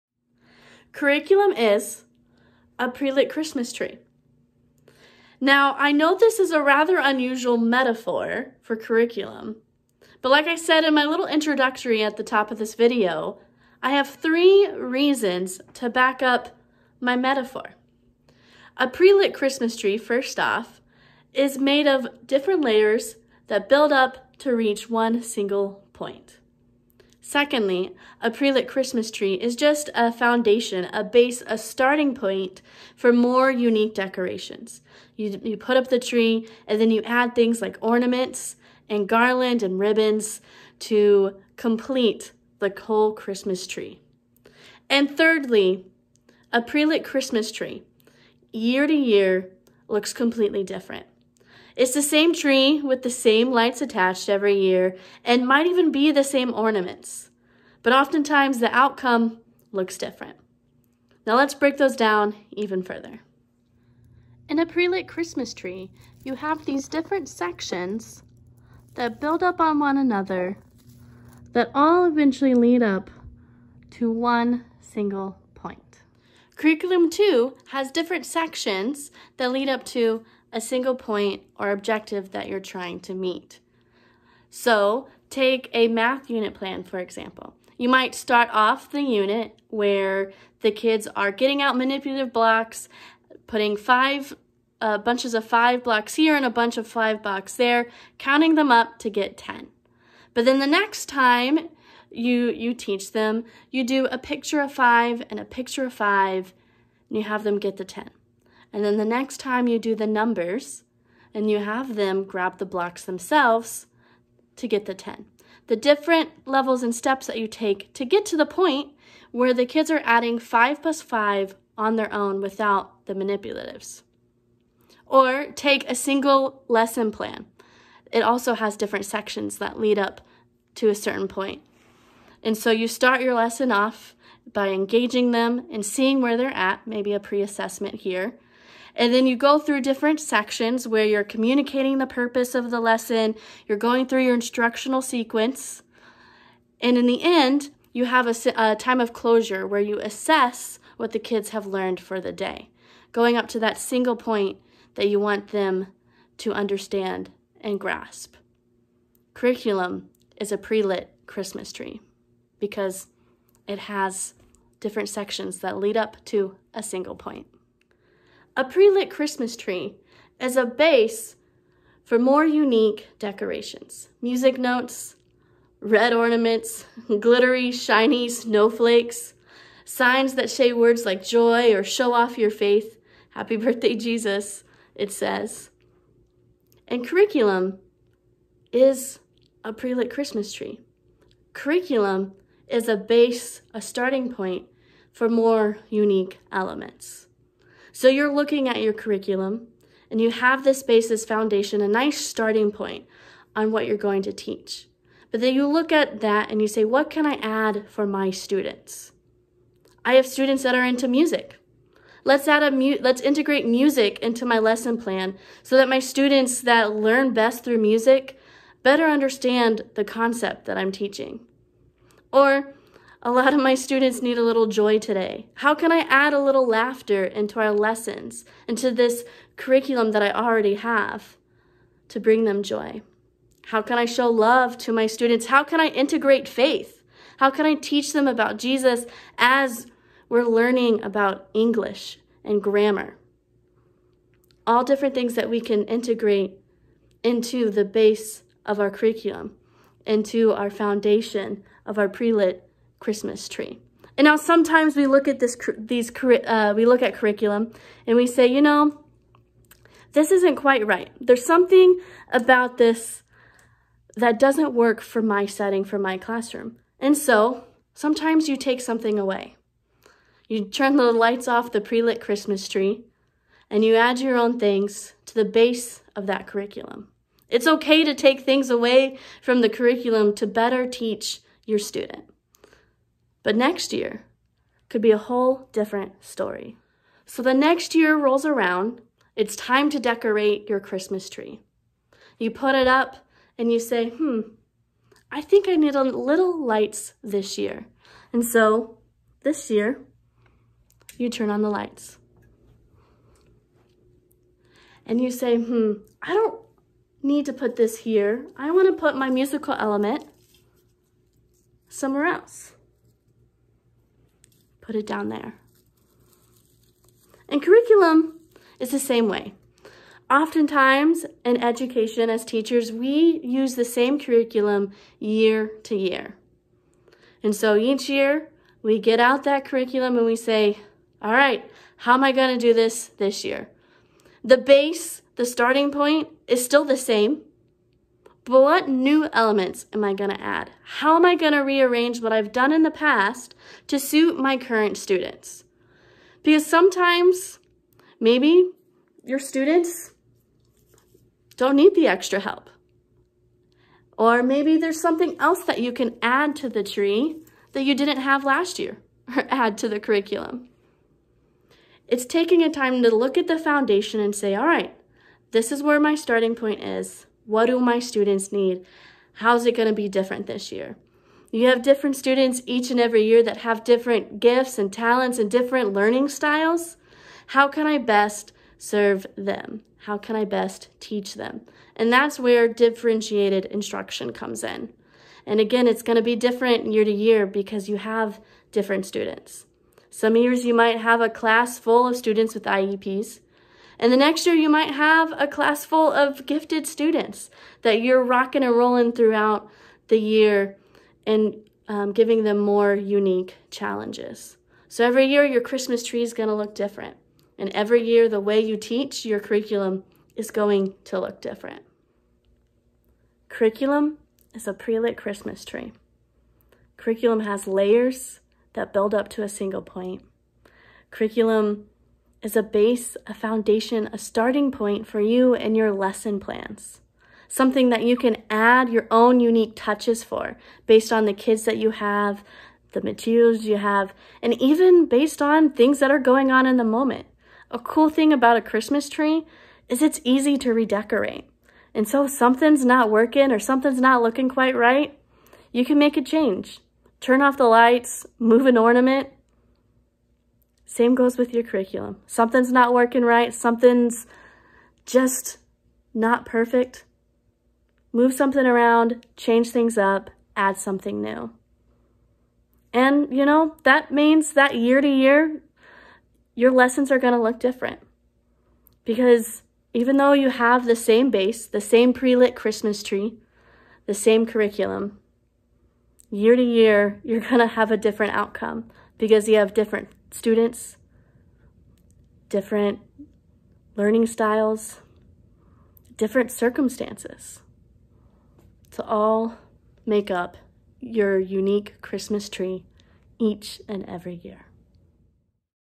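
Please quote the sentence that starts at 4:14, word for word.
And now sometimes we look at this, these, uh, we look at curriculum and we say, you know, this isn't quite right.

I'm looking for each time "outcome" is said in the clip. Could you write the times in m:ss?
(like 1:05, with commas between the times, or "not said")
0:58, 7:58.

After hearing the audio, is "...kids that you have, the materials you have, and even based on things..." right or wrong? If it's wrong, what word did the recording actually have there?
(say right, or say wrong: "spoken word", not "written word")
right.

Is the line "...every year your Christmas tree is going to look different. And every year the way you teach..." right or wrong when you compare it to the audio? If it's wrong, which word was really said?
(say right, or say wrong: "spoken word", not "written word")
right.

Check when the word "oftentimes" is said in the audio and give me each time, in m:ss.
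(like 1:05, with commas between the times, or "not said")
0:57, 5:20.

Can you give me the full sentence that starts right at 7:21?
And so something's not working or something's not looking quite right, you can make a change.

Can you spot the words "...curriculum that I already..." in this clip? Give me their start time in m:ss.
3:49.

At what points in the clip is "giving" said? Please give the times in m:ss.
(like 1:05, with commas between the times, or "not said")
6:42.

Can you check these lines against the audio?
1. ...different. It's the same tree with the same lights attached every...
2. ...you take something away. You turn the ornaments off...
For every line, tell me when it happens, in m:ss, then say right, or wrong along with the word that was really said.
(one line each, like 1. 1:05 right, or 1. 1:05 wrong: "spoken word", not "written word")
1. 0:50 right
2. 4:28 wrong: "lights", not "ornaments".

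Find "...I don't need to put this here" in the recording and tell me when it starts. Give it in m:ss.
5:06.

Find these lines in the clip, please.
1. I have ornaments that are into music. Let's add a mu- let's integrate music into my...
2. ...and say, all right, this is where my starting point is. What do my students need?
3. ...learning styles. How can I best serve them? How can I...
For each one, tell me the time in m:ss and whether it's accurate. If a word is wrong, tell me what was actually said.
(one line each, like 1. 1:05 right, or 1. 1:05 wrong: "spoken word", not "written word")
1. 3:30 wrong: "students", not "ornaments"
2. 6:04 right
3. 6:15 right.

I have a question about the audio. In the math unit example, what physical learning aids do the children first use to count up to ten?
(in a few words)
manipulative blocks.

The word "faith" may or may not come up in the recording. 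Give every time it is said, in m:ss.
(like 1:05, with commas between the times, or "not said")
3:02, 3:56.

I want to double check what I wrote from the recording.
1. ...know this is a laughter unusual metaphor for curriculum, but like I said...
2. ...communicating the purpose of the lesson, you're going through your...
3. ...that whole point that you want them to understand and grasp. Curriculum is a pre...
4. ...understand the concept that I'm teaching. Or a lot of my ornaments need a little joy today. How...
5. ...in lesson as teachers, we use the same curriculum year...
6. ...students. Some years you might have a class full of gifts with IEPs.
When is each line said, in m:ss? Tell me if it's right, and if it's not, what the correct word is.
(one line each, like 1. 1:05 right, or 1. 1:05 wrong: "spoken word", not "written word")
1. 0:05 wrong: "rather", not "laughter"
2. 2:21 right
3. 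2:33 wrong: "single", not "whole"
4. 3:39 wrong: "students", not "ornaments"
5. 5:21 wrong: "education", not "lesson"
6. 6:29 wrong: "students", not "gifts".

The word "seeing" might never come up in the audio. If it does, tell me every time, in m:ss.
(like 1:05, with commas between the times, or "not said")
2:15.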